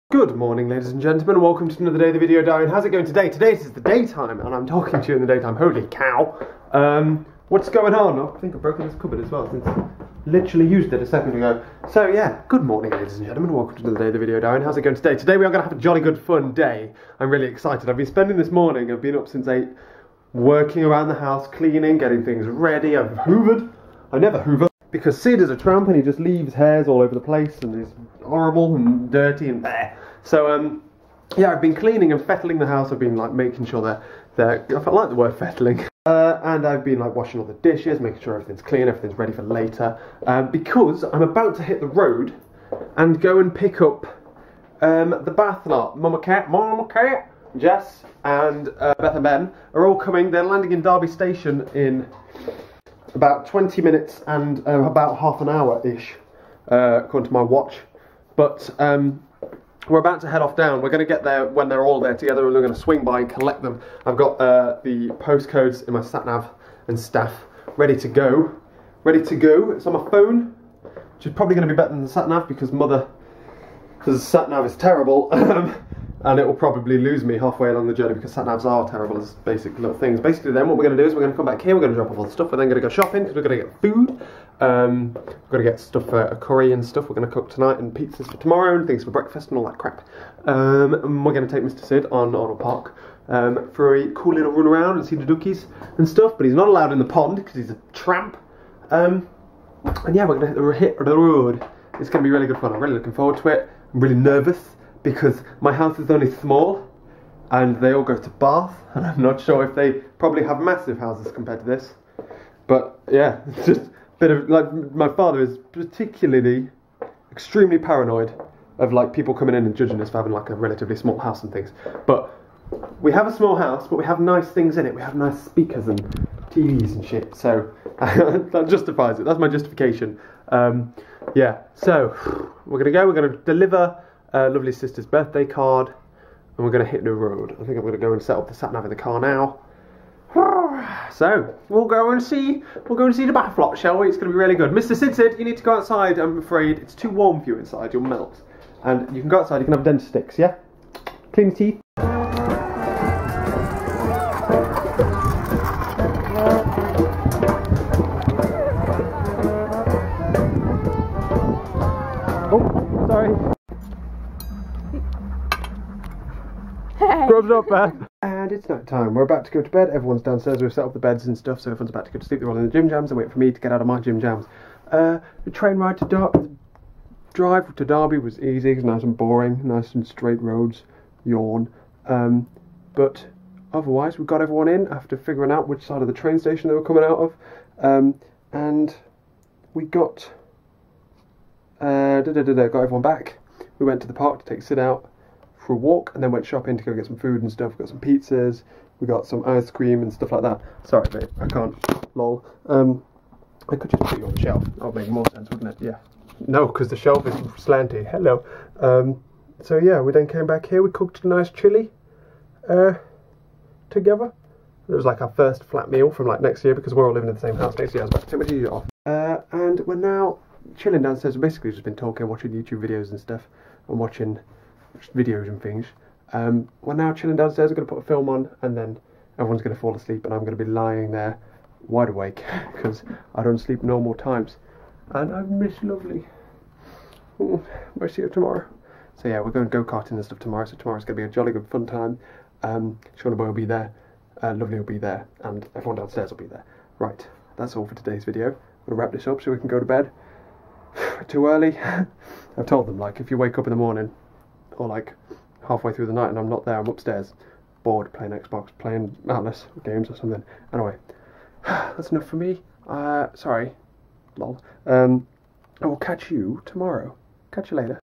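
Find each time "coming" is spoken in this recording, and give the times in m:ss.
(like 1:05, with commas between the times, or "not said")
0:49, 1:59, 3:06.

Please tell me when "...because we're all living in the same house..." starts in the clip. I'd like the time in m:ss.
3:36.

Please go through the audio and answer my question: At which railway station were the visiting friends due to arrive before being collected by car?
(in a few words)
Derby Station.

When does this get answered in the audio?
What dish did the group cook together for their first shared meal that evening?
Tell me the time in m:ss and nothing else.
3:31.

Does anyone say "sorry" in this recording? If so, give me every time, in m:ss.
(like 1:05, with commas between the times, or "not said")
2:43, 3:20, 4:23.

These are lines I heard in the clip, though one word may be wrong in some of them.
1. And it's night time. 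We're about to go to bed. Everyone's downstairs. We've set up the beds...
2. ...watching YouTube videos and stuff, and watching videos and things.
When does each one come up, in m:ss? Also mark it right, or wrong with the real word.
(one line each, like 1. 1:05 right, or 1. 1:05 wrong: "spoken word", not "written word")
1. 2:48 right
2. 3:42 right.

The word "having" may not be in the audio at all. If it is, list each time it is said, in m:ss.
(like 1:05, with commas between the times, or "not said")
2:00.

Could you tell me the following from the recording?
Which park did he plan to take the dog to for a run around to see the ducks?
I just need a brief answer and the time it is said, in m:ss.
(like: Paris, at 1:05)
Arnold Park, at 1:32.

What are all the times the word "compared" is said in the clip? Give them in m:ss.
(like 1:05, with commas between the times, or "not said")
1:51.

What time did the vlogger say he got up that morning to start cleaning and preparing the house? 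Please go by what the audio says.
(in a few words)
8.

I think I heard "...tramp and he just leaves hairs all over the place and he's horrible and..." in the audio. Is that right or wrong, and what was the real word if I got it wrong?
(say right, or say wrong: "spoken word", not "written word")
right.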